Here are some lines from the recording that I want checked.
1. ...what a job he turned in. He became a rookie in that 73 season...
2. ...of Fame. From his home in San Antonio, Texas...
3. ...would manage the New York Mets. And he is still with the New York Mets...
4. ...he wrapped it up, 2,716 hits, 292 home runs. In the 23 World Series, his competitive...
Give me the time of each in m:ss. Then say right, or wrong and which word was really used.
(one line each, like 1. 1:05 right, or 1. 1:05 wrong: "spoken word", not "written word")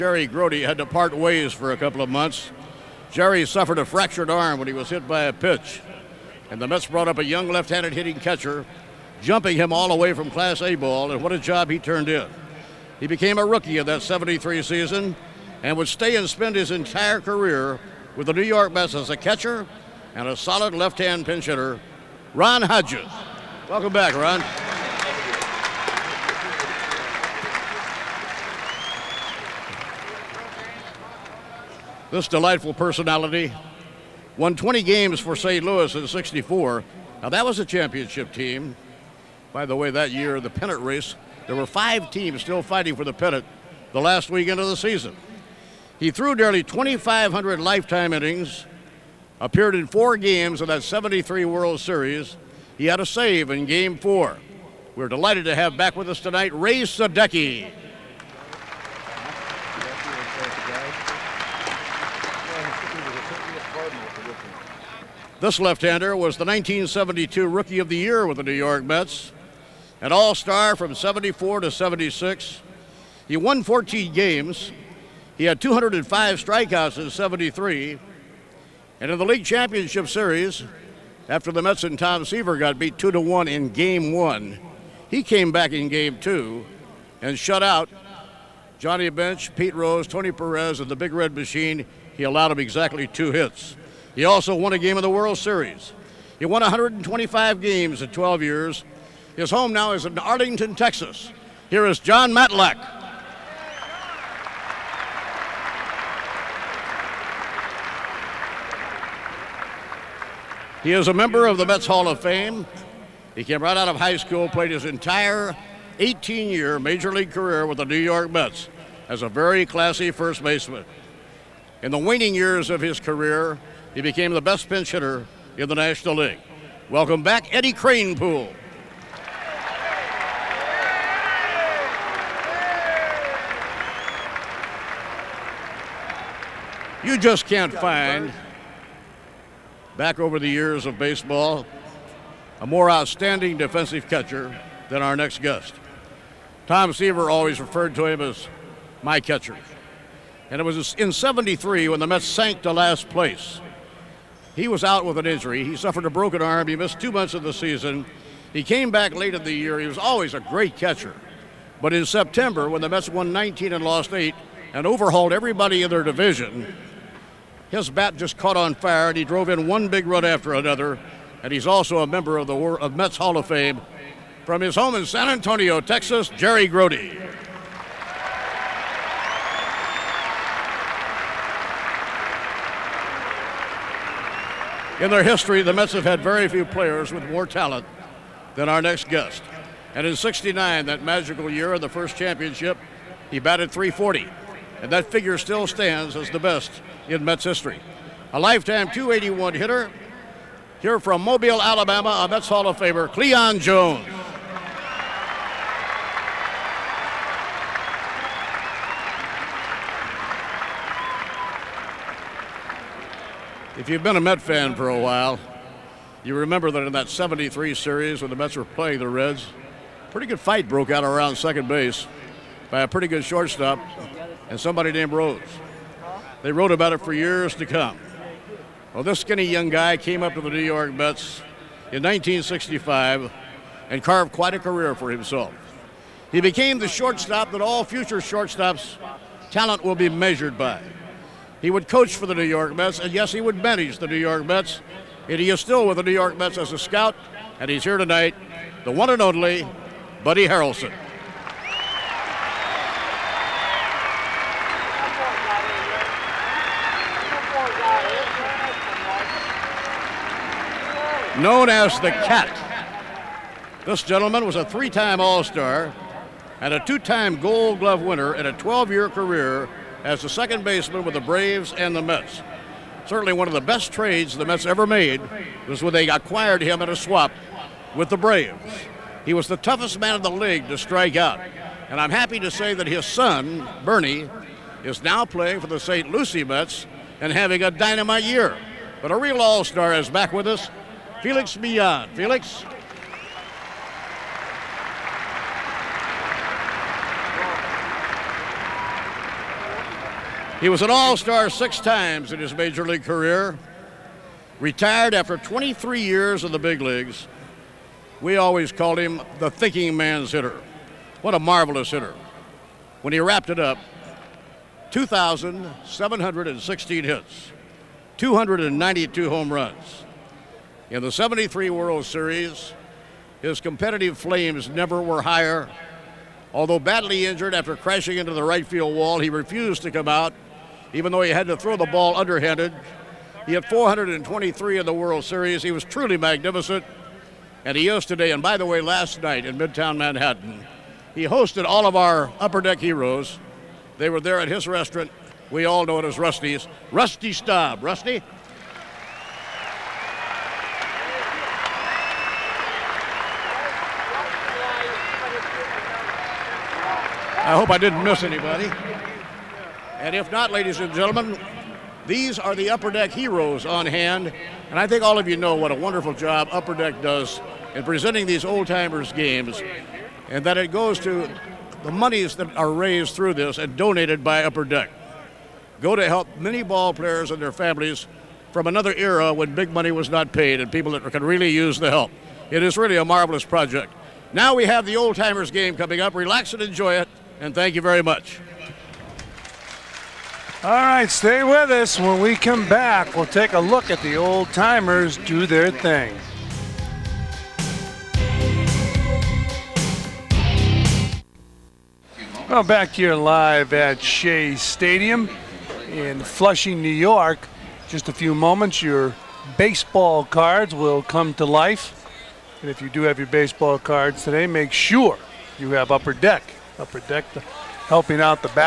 1. 0:11 right
2. 2:53 right
3. 4:03 right
4. 5:13 wrong: "73", not "23".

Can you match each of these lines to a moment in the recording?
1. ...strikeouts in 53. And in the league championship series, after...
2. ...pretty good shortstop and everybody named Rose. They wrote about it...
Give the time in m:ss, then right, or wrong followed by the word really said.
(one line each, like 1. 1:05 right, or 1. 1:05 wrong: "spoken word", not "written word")
1. 1:16 wrong: "73", not "53"
2. 3:42 wrong: "somebody", not "everybody".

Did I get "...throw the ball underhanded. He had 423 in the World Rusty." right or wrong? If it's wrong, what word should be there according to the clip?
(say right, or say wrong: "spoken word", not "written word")
wrong: "Series", not "Rusty".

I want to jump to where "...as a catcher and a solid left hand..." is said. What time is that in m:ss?
0:18.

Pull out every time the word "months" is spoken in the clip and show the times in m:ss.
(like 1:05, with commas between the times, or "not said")
0:02, 2:37.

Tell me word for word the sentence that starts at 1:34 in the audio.
He also won a game of the World Series.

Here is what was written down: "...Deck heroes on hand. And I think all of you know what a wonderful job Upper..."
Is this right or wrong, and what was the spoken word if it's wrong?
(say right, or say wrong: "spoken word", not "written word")
right.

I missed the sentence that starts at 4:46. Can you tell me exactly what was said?
Lucie Mets and having a dynamite year.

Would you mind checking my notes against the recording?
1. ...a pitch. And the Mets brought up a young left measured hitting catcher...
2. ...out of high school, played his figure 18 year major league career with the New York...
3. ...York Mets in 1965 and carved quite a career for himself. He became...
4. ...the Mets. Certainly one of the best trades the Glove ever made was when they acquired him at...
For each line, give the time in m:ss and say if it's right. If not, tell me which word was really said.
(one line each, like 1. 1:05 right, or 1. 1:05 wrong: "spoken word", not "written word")
1. 0:05 wrong: "handed", not "measured"
2. 1:53 wrong: "entire", not "figure"
3. 3:50 right
4. 4:31 wrong: "Mets", not "Glove".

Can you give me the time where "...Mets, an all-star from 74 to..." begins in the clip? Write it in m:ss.
1:08.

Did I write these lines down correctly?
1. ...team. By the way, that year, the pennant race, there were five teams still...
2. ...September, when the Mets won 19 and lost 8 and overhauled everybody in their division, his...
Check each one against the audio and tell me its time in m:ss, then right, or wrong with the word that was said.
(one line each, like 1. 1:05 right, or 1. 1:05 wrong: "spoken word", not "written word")
1. 0:38 right
2. 2:42 right.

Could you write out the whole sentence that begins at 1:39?
His home now is in Arlington, Texas.